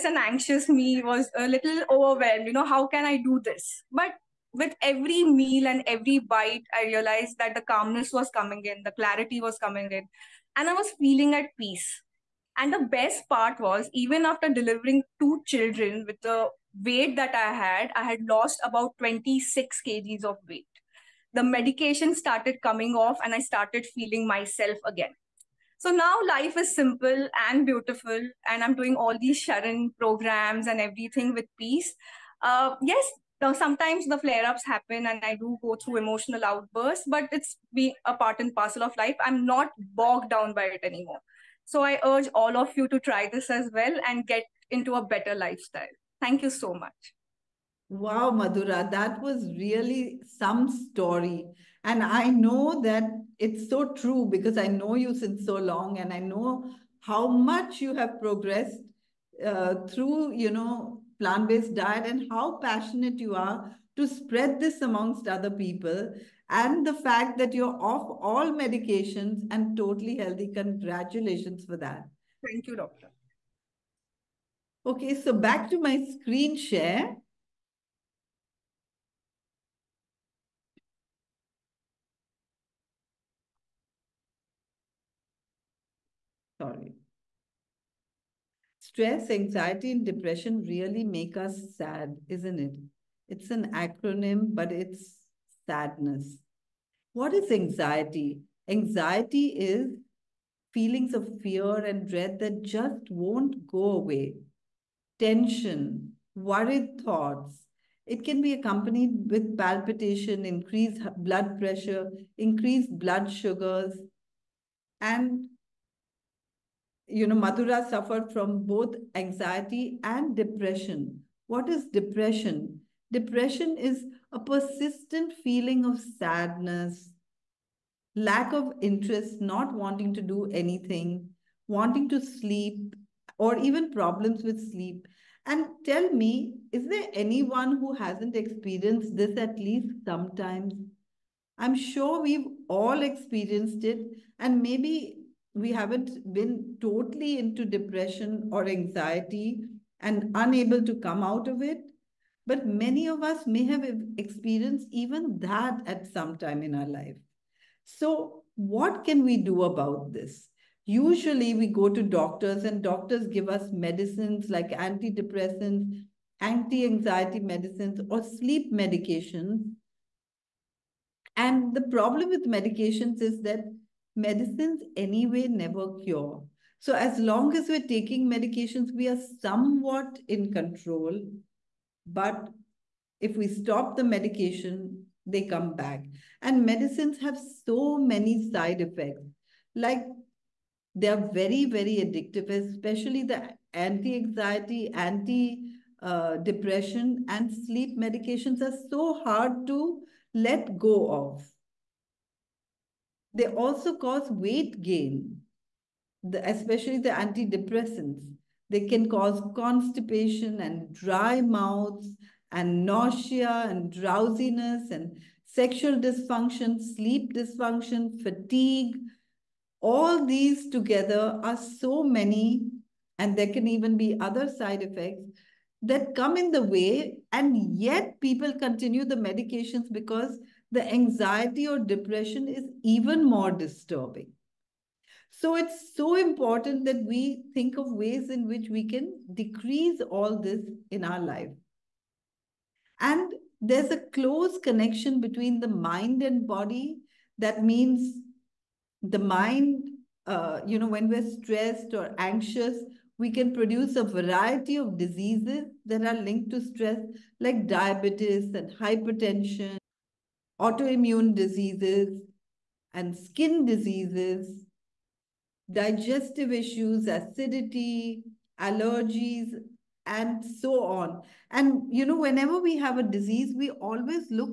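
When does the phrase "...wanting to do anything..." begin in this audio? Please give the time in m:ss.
2:09.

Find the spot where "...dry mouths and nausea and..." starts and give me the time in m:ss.
3:30.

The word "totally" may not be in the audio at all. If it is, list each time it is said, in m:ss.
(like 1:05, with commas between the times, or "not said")
1:09, 2:26.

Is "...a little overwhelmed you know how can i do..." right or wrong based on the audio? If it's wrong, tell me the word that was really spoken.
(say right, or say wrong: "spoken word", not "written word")
right.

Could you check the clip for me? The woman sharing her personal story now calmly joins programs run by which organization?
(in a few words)
Sharan.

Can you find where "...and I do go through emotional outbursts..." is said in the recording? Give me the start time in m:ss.
0:35.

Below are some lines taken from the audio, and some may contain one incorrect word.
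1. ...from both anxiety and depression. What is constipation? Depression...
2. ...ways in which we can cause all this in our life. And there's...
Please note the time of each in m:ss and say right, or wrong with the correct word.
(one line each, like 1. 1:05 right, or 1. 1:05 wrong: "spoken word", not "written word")
1. 1:58 wrong: "depression", not "constipation"
2. 3:57 wrong: "decrease", not "cause".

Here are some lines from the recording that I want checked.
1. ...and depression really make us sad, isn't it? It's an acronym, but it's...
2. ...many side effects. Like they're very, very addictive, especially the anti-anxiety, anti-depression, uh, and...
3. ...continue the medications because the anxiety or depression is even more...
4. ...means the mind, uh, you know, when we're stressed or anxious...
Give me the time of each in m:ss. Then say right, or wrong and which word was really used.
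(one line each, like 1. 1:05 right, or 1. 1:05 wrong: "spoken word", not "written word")
1. 1:29 right
2. 3:07 right
3. 3:48 right
4. 4:07 right.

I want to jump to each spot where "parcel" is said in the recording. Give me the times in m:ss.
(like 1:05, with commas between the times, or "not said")
0:38.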